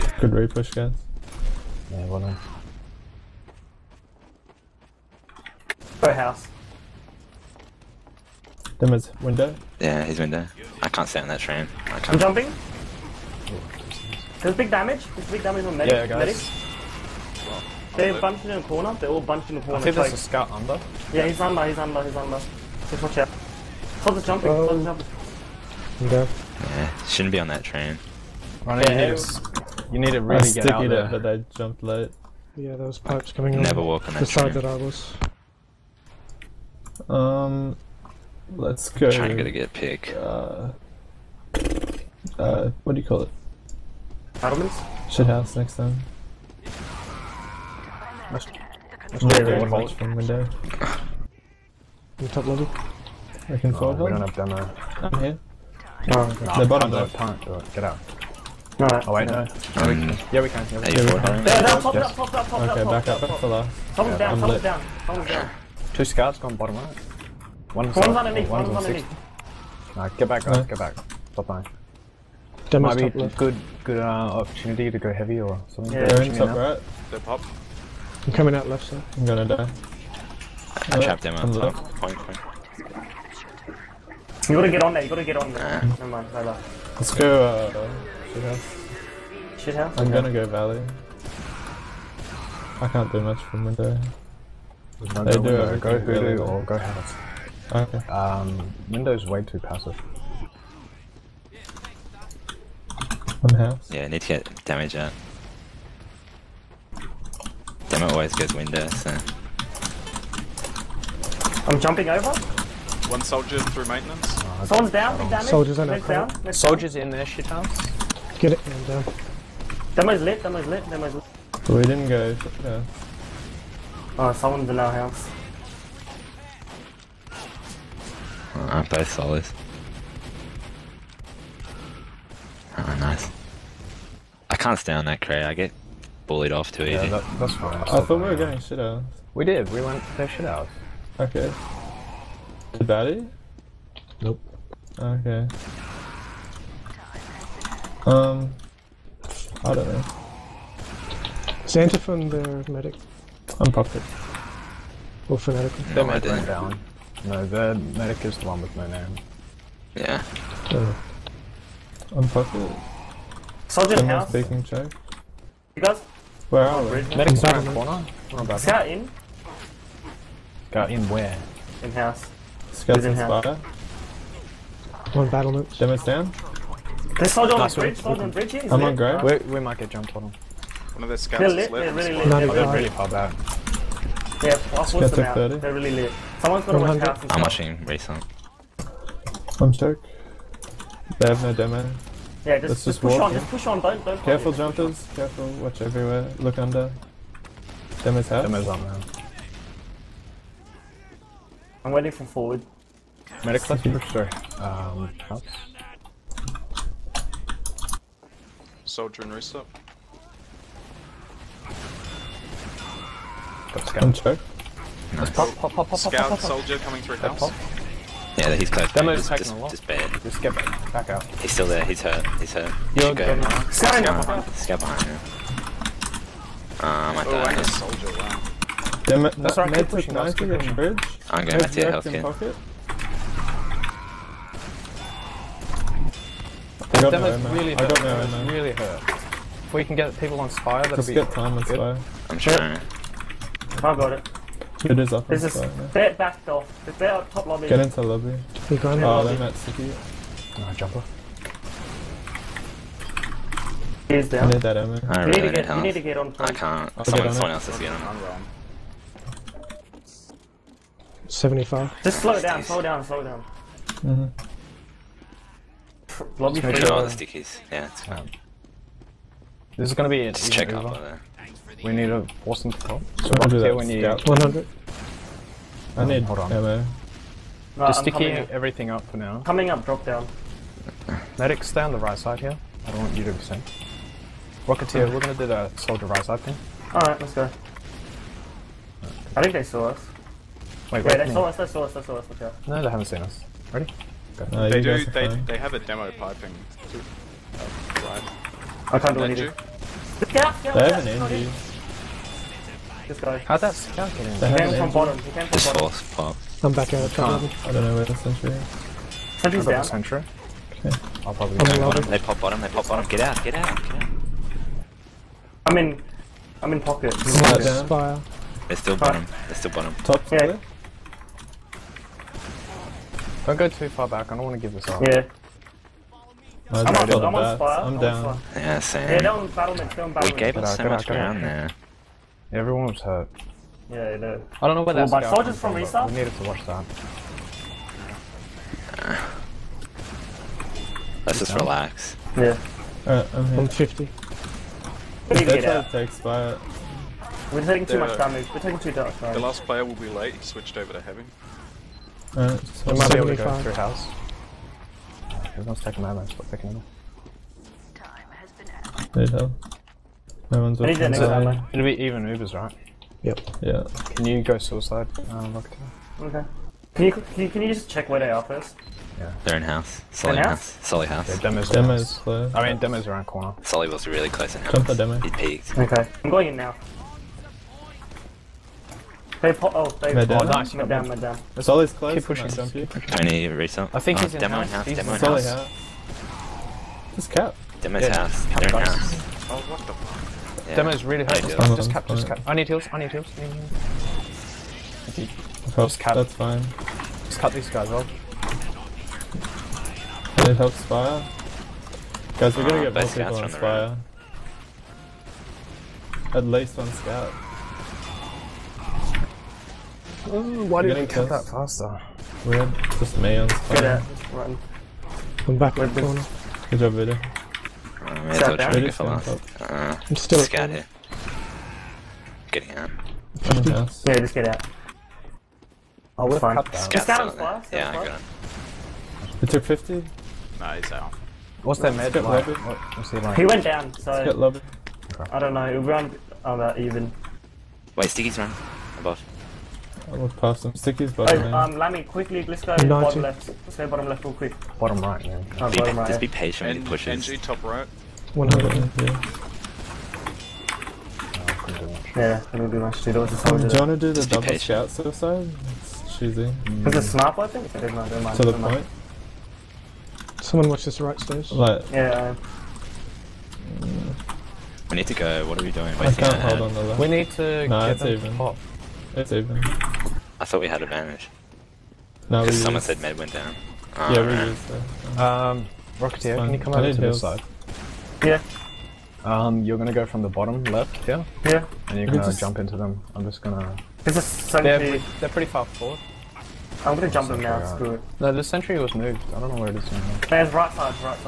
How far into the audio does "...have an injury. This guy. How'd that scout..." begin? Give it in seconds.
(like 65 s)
300 s.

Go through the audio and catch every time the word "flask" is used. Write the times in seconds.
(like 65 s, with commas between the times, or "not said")
427 s.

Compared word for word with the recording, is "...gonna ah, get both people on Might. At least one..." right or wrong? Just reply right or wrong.
wrong.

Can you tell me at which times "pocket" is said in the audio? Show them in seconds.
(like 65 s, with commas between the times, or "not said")
316 s.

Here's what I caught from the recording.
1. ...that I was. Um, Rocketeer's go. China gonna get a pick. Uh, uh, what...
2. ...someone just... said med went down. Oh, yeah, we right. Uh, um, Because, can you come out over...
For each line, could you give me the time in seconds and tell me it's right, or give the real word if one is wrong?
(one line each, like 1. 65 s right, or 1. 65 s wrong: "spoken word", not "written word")
1. 34 s wrong: "Let", not "Rocketeer"
2. 472 s wrong: "Rocketeer", not "Because".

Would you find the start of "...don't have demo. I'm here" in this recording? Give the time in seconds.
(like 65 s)
54 s.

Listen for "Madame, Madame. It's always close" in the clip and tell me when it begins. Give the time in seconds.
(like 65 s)
380 s.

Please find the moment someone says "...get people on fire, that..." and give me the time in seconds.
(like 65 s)
239 s.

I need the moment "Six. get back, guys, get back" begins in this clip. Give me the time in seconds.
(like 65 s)
69 s.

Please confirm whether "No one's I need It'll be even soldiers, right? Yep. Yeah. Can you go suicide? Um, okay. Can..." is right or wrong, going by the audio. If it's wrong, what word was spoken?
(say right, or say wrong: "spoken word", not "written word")
wrong: "movers", not "soldiers".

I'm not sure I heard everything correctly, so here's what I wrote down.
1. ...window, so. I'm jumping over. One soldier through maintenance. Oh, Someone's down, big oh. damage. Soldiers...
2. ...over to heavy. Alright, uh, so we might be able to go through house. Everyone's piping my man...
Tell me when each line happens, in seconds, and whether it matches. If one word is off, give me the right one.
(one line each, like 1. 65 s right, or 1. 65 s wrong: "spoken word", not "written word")
1. 108 s right
2. 350 s wrong: "taking", not "piping".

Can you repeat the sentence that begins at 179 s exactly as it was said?
We, might get jumped on him.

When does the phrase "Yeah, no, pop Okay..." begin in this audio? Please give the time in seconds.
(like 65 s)
61 s.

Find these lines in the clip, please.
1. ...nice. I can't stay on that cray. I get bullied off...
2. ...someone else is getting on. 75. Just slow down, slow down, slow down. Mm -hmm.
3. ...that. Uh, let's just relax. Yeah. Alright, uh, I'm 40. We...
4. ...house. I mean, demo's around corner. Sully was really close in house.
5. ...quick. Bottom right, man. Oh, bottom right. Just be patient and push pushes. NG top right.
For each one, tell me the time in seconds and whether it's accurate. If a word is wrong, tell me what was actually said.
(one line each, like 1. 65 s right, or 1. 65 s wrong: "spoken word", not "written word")
1. 132 s right
2. 257 s right
3. 336 s wrong: "50", not "40"
4. 372 s right
5. 444 s right.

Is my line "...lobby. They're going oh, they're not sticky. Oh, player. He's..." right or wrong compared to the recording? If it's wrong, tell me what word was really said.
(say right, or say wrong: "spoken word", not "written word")
wrong: "jumper", not "player".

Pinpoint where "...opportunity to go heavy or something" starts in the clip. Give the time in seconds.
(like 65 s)
74 s.